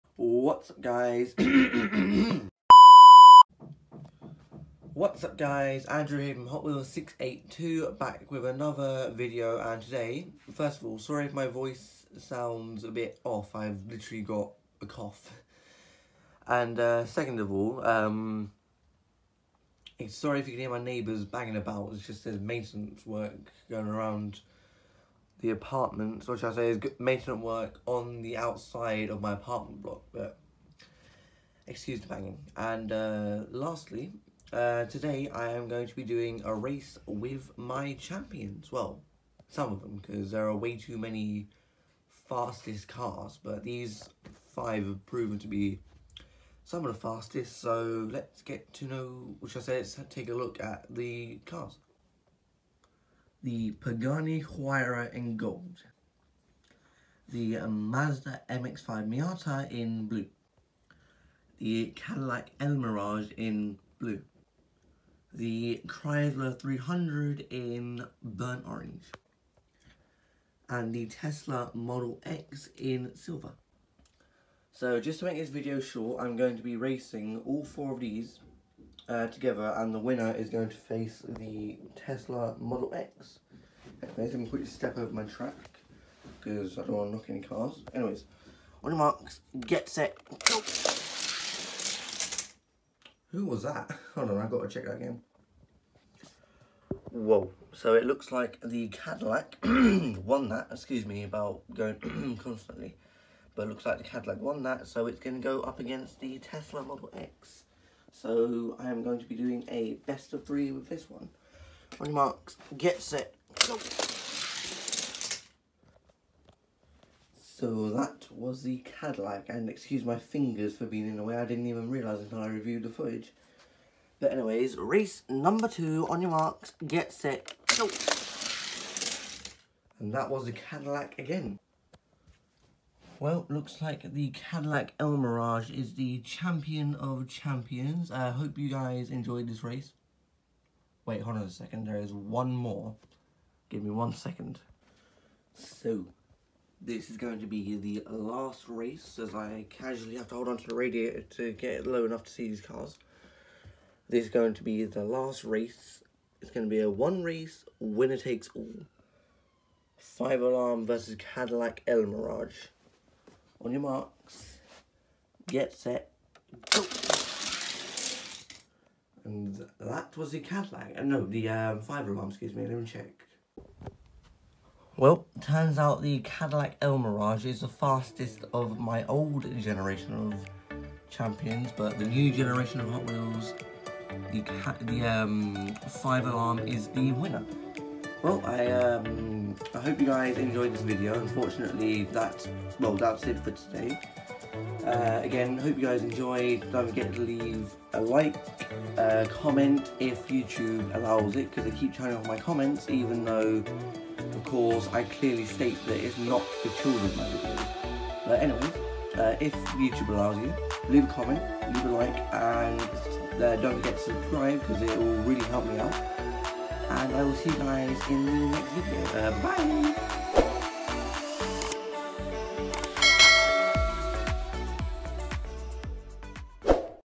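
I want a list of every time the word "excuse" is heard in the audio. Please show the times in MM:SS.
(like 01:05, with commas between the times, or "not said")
00:31, 01:40, 01:59, 02:52.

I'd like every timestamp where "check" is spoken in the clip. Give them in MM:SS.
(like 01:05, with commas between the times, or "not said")
01:34, 02:52.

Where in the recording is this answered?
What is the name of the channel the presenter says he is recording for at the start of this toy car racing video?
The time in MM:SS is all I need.
00:06.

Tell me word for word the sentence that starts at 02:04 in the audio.
But anyways, race number two, on your marks, get set, go.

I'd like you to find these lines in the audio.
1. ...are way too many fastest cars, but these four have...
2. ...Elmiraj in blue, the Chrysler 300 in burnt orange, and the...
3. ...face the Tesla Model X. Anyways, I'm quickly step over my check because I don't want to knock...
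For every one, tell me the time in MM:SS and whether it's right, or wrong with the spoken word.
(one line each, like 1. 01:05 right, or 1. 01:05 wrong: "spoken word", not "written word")
1. 00:40 wrong: "five", not "four"
2. 01:02 right
3. 01:20 wrong: "track", not "check".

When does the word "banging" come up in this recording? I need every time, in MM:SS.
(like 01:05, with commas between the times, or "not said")
00:21, 00:32.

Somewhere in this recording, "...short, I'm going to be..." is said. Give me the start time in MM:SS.
01:15.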